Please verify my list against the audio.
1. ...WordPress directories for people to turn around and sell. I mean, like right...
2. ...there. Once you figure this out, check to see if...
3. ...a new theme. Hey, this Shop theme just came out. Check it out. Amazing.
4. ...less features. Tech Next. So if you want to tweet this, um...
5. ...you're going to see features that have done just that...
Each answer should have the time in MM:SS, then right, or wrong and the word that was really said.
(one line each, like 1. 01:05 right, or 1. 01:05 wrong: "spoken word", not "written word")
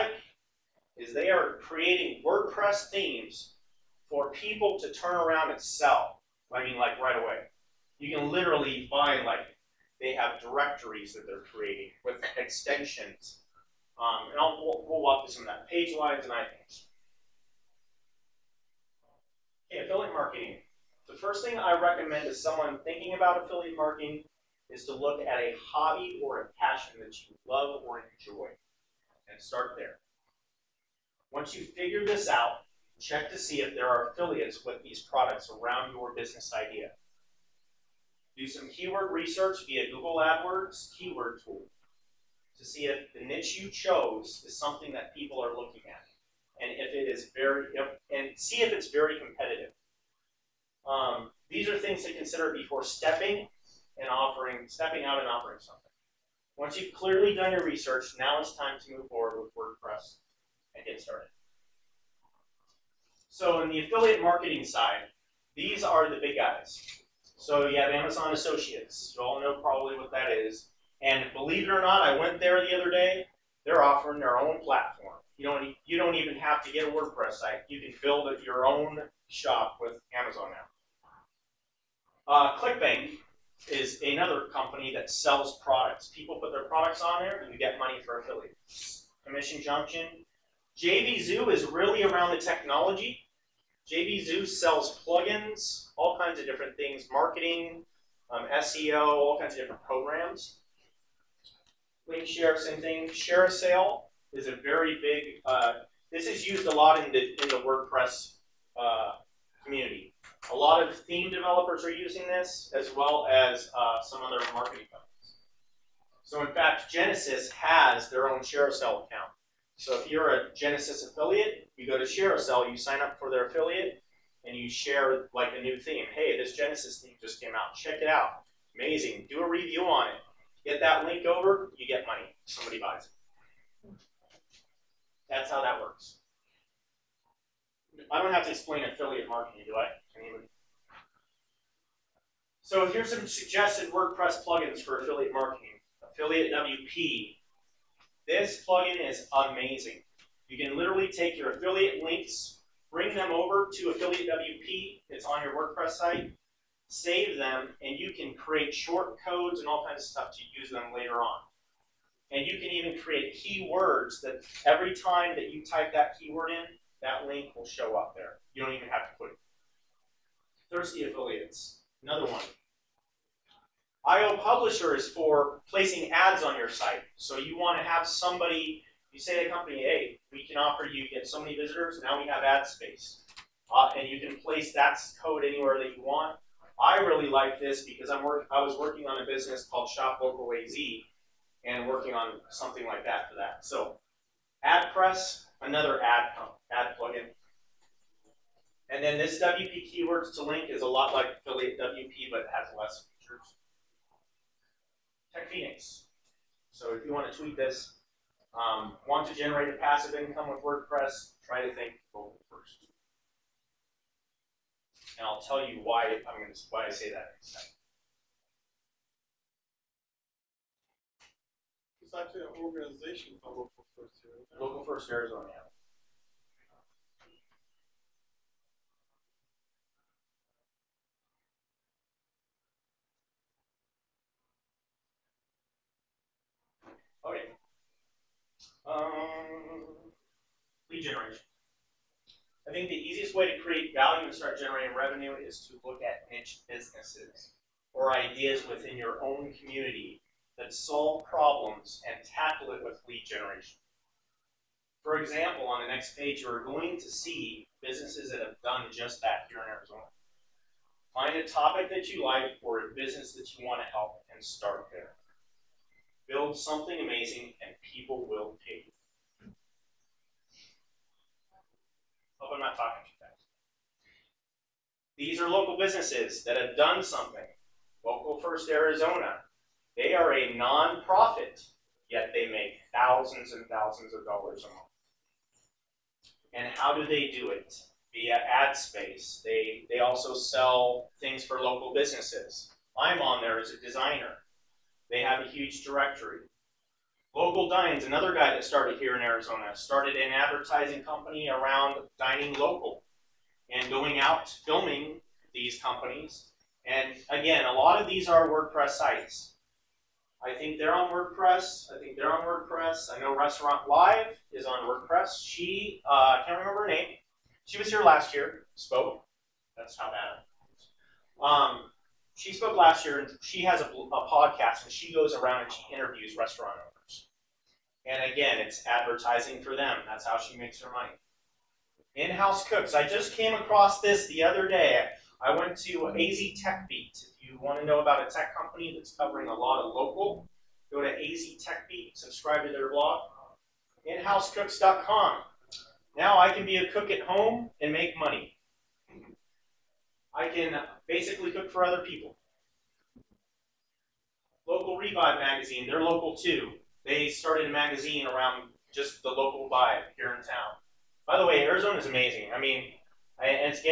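1. 00:02 wrong: "themes", not "directories"
2. 00:29 right
3. 02:05 wrong: "Genesis", not "Shop"
4. 03:22 wrong: "Phoenix", not "Next"
5. 04:16 wrong: "businesses", not "features".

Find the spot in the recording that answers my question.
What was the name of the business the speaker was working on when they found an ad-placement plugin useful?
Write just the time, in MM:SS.
03:09.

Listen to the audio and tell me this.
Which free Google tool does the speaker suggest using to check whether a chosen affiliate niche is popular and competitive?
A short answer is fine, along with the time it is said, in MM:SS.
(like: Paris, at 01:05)
Google AdWords keyword tool, at 00:39.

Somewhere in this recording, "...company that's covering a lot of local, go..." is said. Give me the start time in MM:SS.
05:38.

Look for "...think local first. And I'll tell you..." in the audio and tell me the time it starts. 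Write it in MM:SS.
03:31.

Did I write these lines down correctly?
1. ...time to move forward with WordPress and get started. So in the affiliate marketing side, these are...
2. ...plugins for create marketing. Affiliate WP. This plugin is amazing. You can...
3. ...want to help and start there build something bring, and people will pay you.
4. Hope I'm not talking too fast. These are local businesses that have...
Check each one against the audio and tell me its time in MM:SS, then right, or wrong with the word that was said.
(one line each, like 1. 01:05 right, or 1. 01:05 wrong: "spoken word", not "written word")
1. 00:58 right
2. 02:24 wrong: "affiliate", not "create"
3. 04:23 wrong: "amazing", not "bring"
4. 04:32 right.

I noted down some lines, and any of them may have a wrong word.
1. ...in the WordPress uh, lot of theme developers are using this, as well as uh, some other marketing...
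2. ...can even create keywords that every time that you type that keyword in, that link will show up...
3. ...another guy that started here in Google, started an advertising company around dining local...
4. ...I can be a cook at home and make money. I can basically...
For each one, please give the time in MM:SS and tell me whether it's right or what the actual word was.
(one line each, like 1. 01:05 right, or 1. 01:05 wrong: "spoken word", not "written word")
1. 01:47 right
2. 02:42 right
3. 04:58 wrong: "Arizona", not "Google"
4. 05:46 right.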